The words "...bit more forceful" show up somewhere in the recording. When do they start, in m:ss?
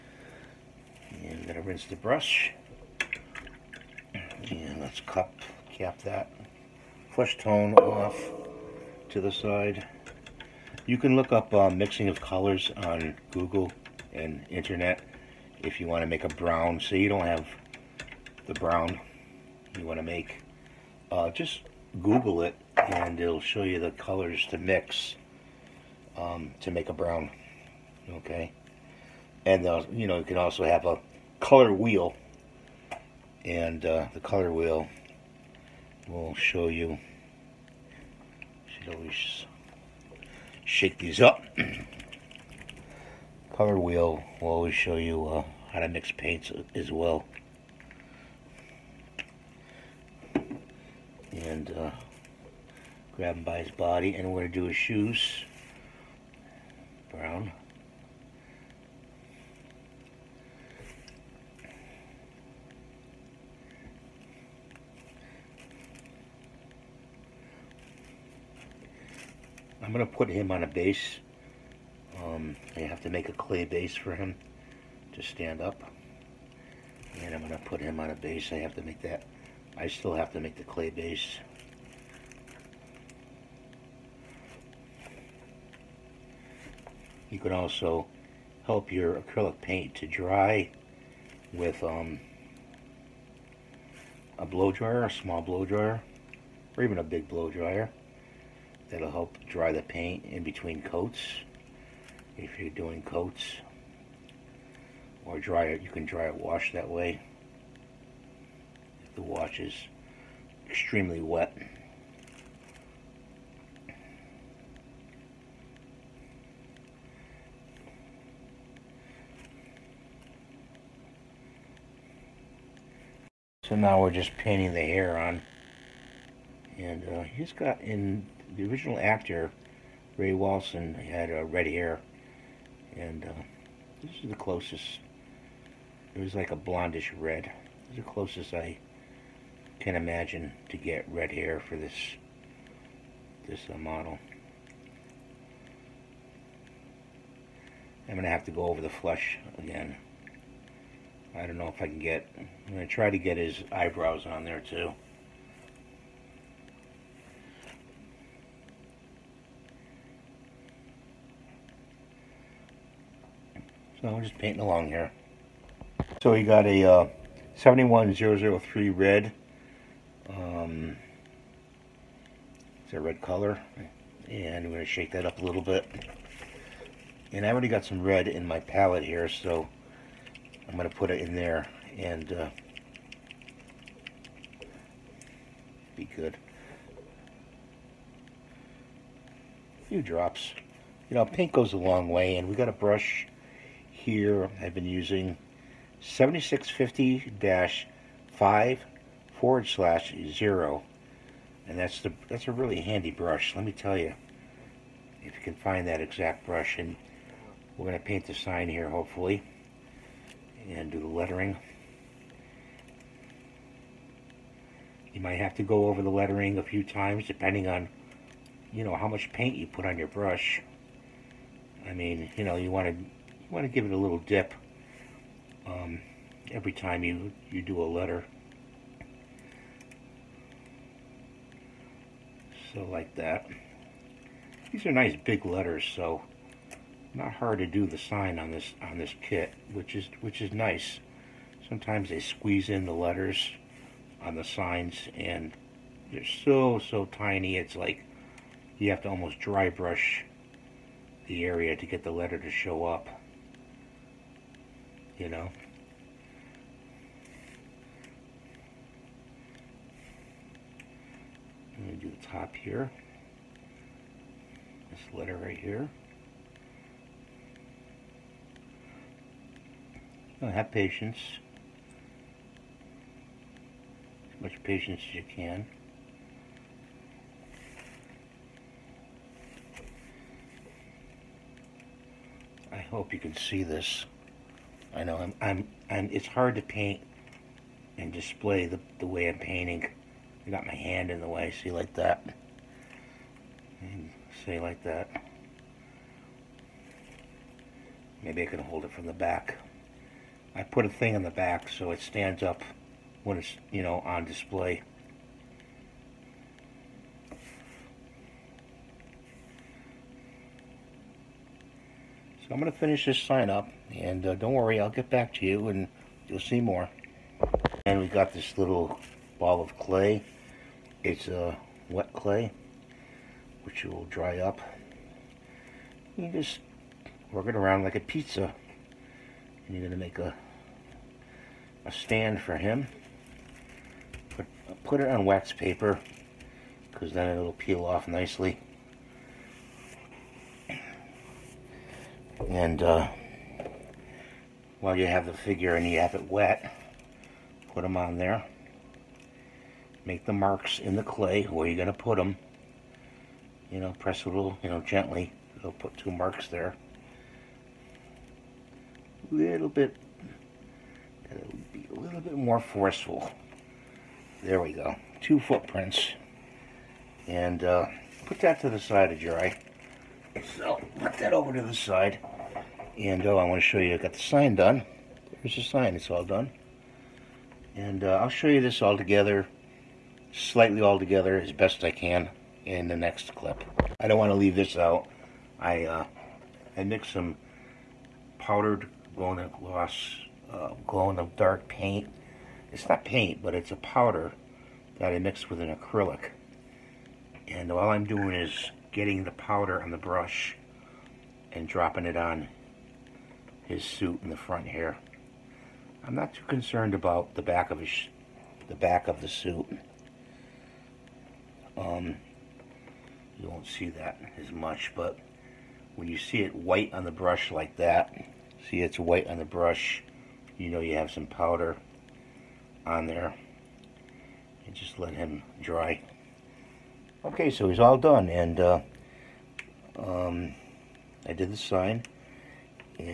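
6:02.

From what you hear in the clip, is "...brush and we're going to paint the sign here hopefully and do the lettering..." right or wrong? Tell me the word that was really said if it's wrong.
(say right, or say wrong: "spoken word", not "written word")
right.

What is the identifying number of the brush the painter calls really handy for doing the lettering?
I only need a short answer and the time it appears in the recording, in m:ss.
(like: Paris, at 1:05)
7650-5/0, at 3:16.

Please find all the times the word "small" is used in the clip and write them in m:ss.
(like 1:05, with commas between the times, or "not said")
1:35.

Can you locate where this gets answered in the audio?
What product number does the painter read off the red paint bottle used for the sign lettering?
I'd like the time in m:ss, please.
2:47.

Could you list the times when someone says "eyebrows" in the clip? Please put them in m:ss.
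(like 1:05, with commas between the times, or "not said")
2:33.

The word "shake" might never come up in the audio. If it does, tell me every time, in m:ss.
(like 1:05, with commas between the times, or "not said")
0:40, 2:54.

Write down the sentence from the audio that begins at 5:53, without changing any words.
You know, press a little, you know, gently.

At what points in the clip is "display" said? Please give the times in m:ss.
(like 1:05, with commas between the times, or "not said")
4:48, 5:04.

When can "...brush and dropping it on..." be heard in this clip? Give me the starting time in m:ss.
6:39.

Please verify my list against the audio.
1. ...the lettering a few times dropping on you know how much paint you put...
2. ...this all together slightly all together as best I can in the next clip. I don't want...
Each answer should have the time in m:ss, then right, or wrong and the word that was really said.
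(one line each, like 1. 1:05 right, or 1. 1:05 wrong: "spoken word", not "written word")
1. 3:36 wrong: "depending", not "dropping"
2. 6:18 right.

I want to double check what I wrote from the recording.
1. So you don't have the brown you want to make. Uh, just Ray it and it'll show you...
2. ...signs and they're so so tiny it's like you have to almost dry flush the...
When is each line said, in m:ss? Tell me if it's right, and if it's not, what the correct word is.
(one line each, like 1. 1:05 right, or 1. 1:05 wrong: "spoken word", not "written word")
1. 0:16 wrong: "Google", not "Ray"
2. 4:04 wrong: "brush", not "flush".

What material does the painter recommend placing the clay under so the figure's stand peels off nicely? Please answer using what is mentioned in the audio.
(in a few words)
Wax paper.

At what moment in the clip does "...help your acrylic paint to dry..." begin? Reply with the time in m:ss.
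1:28.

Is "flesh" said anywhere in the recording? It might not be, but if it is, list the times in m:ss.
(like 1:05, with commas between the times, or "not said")
0:07.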